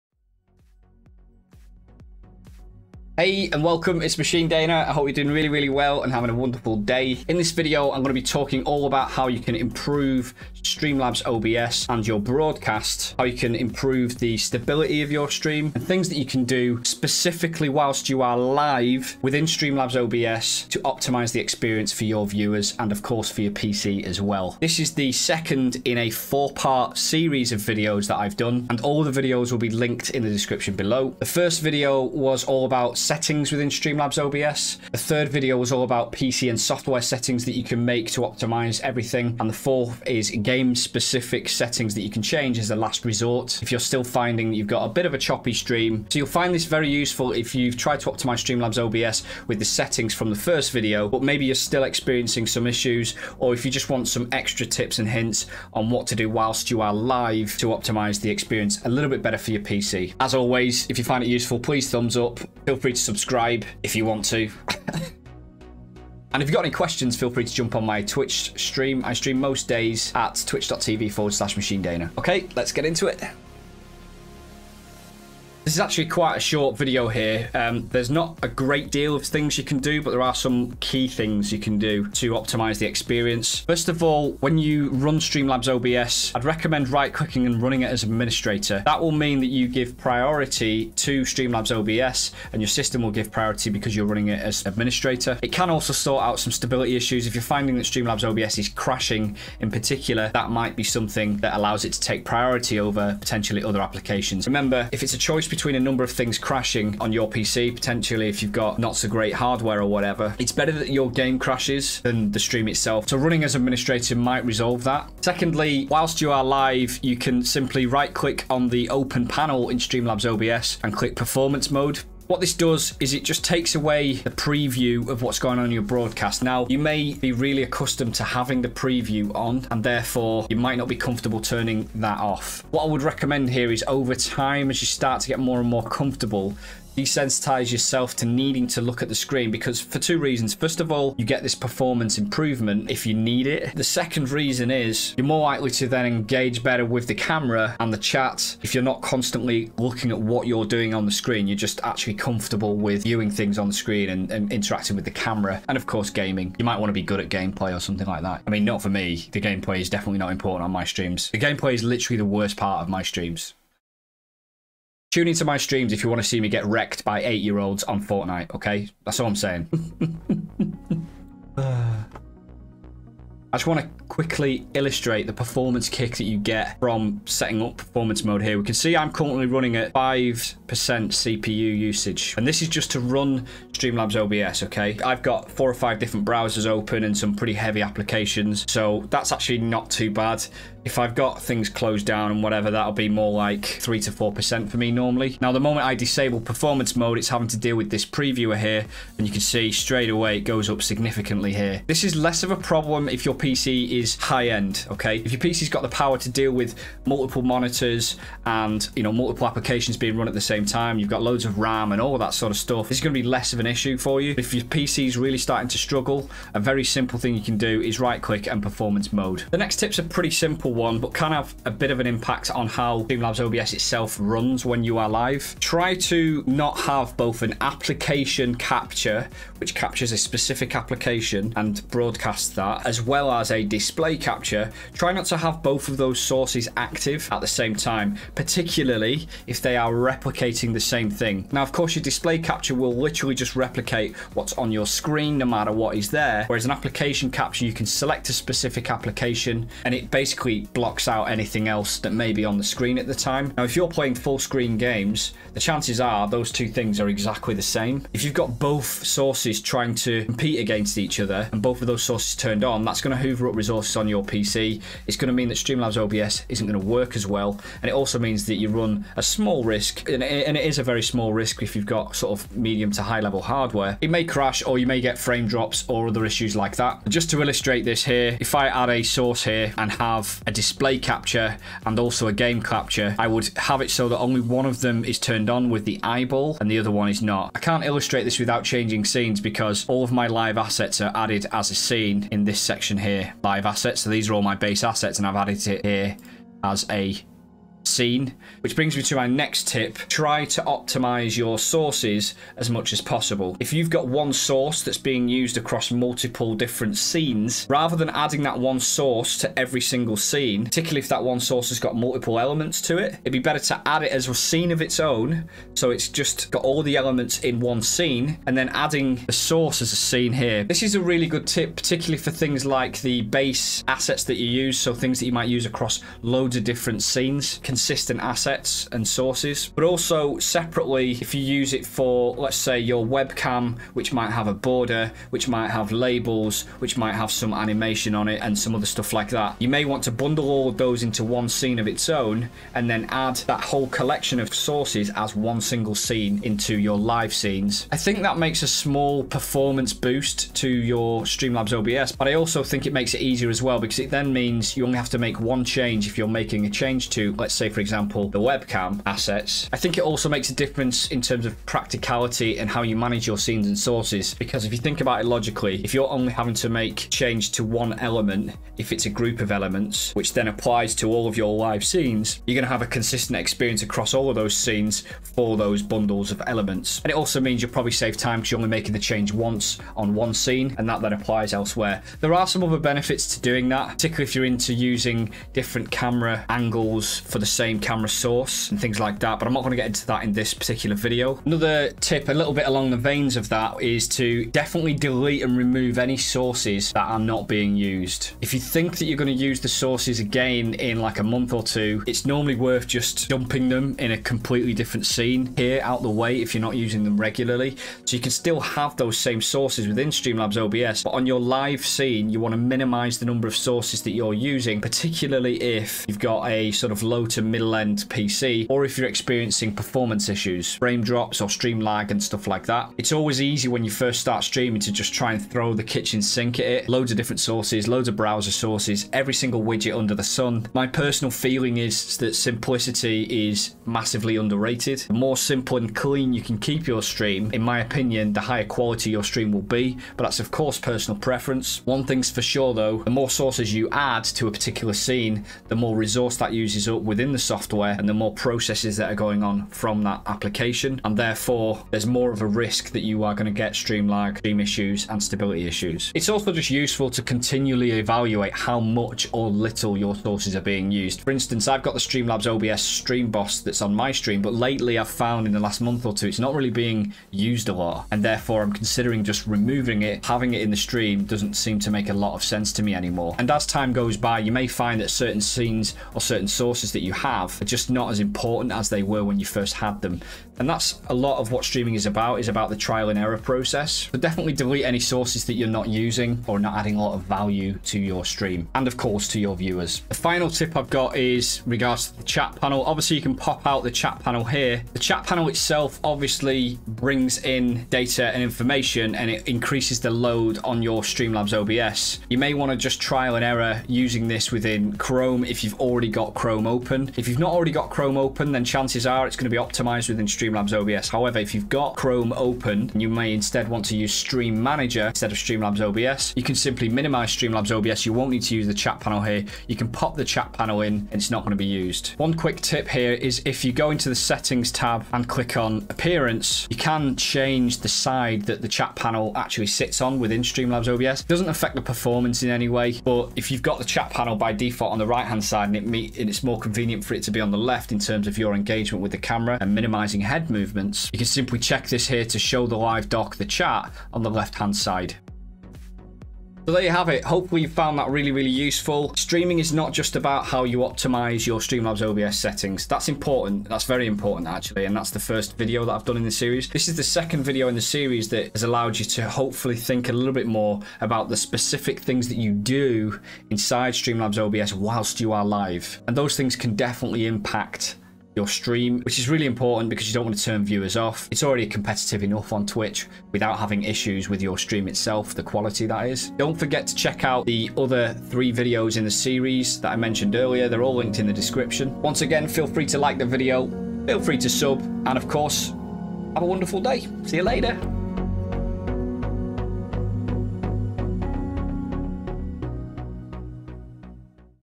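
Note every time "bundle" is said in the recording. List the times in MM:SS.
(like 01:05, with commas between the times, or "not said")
05:40, 06:15.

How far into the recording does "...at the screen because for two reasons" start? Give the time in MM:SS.
02:19.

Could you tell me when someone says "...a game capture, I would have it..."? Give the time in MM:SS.
04:42.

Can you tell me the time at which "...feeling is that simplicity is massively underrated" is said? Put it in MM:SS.
07:11.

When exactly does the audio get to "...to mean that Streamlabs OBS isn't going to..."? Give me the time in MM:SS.
04:25.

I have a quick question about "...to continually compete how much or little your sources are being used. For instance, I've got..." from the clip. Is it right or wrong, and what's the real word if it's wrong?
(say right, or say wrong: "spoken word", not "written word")
wrong: "evaluate", not "compete".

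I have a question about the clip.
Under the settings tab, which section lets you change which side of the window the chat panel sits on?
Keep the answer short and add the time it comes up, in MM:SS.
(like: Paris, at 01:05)
appearance, at 08:45.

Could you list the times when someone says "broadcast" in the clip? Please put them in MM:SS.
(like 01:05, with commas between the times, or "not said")
00:12, 02:05, 03:51.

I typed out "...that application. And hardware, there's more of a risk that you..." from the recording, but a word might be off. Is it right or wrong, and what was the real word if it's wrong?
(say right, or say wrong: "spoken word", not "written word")
wrong: "therefore", not "hardware".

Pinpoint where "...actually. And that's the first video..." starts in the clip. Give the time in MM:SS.
09:14.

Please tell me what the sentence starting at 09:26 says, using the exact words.
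And those things can definitely impact your stream, which is really important because you don't want to turn viewers off.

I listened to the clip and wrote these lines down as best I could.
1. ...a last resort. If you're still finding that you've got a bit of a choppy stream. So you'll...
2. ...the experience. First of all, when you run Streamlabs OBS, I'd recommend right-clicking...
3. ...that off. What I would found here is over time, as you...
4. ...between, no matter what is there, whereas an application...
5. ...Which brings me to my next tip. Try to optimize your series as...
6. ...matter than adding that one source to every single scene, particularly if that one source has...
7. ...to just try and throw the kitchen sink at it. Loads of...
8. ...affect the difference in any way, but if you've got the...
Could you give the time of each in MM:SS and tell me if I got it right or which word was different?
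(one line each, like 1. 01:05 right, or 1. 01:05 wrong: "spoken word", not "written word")
1. 00:42 right
2. 01:22 right
3. 02:11 wrong: "recommend", not "found"
4. 04:04 wrong: "screen", not "between"
5. 04:58 wrong: "sources", not "series"
6. 05:07 wrong: "rather", not "matter"
7. 07:04 right
8. 08:51 wrong: "performance", not "difference".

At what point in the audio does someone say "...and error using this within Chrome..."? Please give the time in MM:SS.
08:23.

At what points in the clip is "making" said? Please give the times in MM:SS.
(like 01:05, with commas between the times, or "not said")
05:56, 06:18.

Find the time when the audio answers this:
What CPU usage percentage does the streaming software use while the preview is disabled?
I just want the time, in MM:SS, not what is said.
02:59.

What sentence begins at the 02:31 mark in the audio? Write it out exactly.
You're just actually comfortable with viewing things on the screen and, and interacting with the camera.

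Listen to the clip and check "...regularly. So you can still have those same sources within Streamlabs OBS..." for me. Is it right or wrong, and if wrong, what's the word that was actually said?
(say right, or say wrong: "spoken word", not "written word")
right.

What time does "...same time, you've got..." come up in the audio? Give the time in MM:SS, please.
03:30.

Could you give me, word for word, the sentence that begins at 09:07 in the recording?
Hopefully you found that really, really useful.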